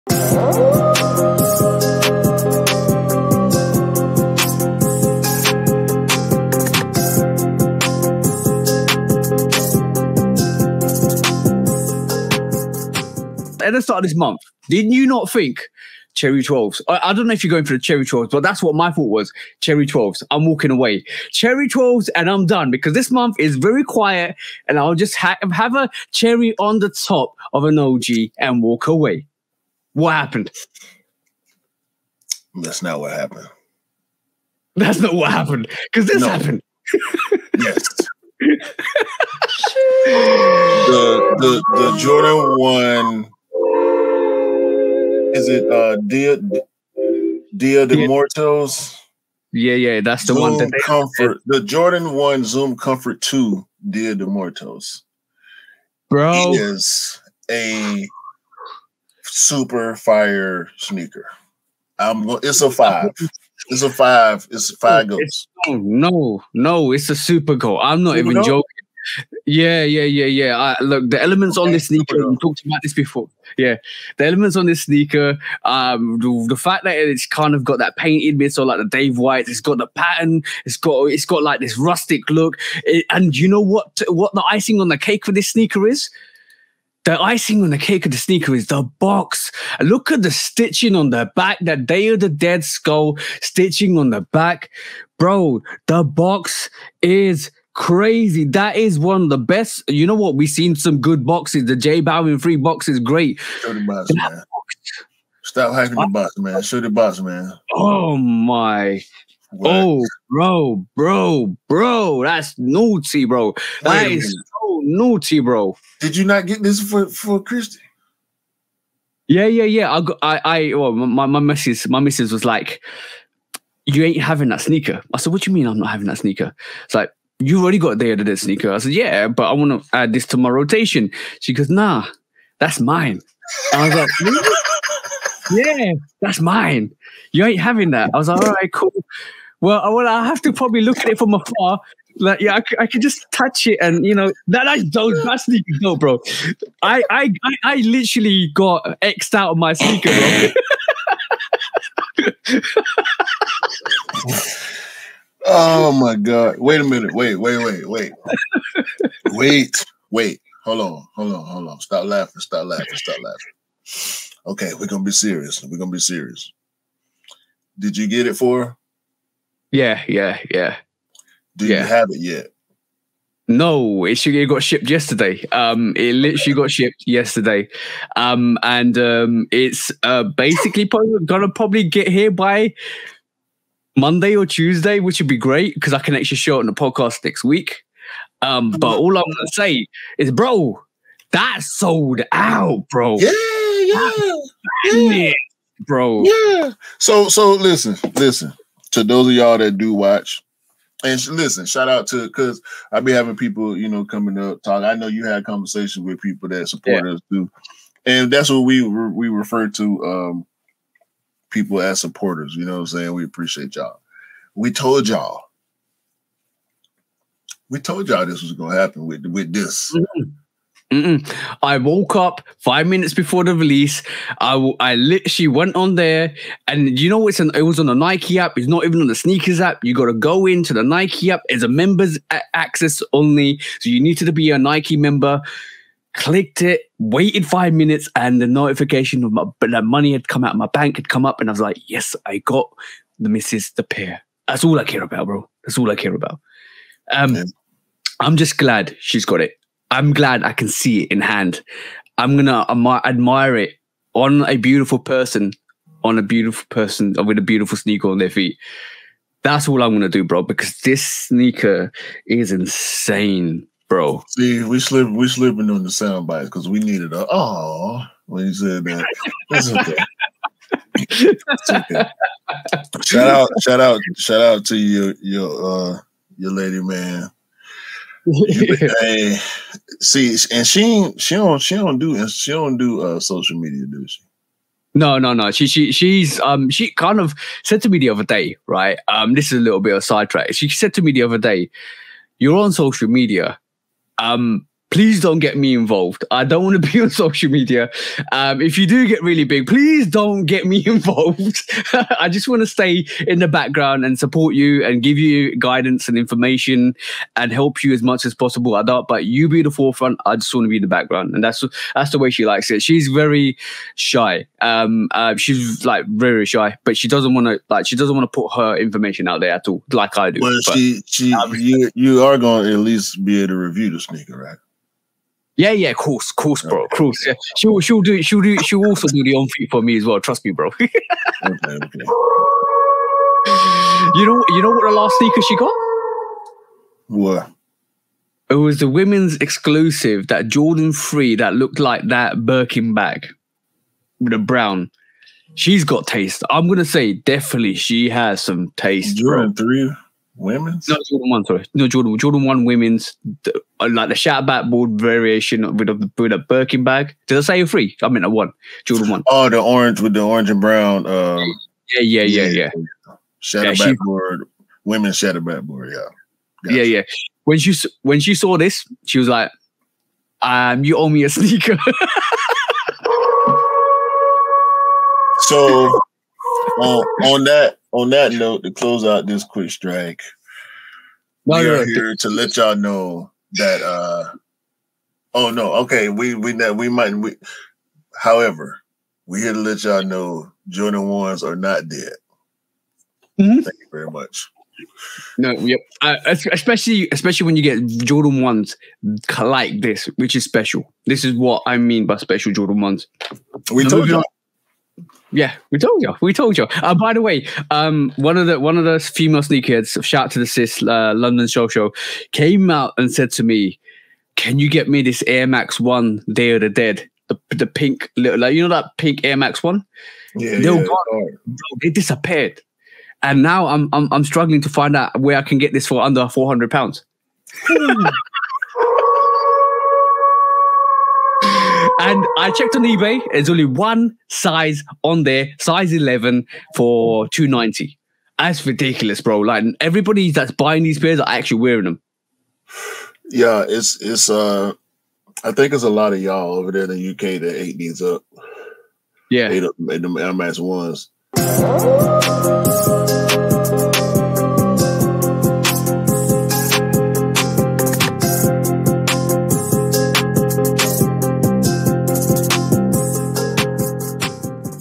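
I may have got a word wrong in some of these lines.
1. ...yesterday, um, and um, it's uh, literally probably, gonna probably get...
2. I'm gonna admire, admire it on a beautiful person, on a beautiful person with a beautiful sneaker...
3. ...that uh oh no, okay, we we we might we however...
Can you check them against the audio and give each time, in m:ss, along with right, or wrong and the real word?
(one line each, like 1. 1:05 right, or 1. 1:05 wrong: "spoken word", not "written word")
1. 2:57 wrong: "basically", not "literally"
2. 4:12 right
3. 6:23 right.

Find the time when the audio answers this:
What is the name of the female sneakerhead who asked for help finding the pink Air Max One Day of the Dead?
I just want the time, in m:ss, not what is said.
6:51.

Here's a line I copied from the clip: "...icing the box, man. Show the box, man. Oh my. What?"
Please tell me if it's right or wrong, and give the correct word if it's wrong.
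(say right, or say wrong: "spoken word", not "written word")
wrong: "hyping", not "icing".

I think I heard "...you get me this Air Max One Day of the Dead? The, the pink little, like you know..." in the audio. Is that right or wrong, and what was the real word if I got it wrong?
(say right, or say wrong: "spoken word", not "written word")
right.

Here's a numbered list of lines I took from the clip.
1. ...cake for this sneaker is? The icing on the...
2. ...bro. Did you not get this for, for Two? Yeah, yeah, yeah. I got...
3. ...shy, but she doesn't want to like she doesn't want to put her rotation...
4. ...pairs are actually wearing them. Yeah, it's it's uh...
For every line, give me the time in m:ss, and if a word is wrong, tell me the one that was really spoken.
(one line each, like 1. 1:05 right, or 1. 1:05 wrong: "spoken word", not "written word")
1. 1:24 right
2. 1:55 wrong: "Christy", not "Two"
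3. 5:16 wrong: "information", not "rotation"
4. 7:20 right.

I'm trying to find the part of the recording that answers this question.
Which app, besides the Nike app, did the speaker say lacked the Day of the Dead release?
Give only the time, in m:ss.
3:49.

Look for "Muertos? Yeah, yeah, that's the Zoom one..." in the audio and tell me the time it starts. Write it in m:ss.
0:48.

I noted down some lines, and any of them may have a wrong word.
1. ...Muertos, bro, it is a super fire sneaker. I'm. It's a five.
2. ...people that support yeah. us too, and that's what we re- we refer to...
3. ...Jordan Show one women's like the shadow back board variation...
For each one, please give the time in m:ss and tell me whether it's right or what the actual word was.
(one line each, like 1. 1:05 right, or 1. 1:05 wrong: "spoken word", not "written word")
1. 0:54 right
2. 3:26 right
3. 5:51 wrong: "Jordan", not "Show".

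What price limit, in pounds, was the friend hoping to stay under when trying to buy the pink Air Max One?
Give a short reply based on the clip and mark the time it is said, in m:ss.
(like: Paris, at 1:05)
£400, at 7:06.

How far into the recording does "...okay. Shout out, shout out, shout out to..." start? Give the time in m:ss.
4:31.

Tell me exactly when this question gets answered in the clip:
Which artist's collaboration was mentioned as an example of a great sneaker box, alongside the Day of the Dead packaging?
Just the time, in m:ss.
1:41.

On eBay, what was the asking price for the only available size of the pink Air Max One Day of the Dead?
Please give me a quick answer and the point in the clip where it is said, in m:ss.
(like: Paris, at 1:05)
290, at 7:17.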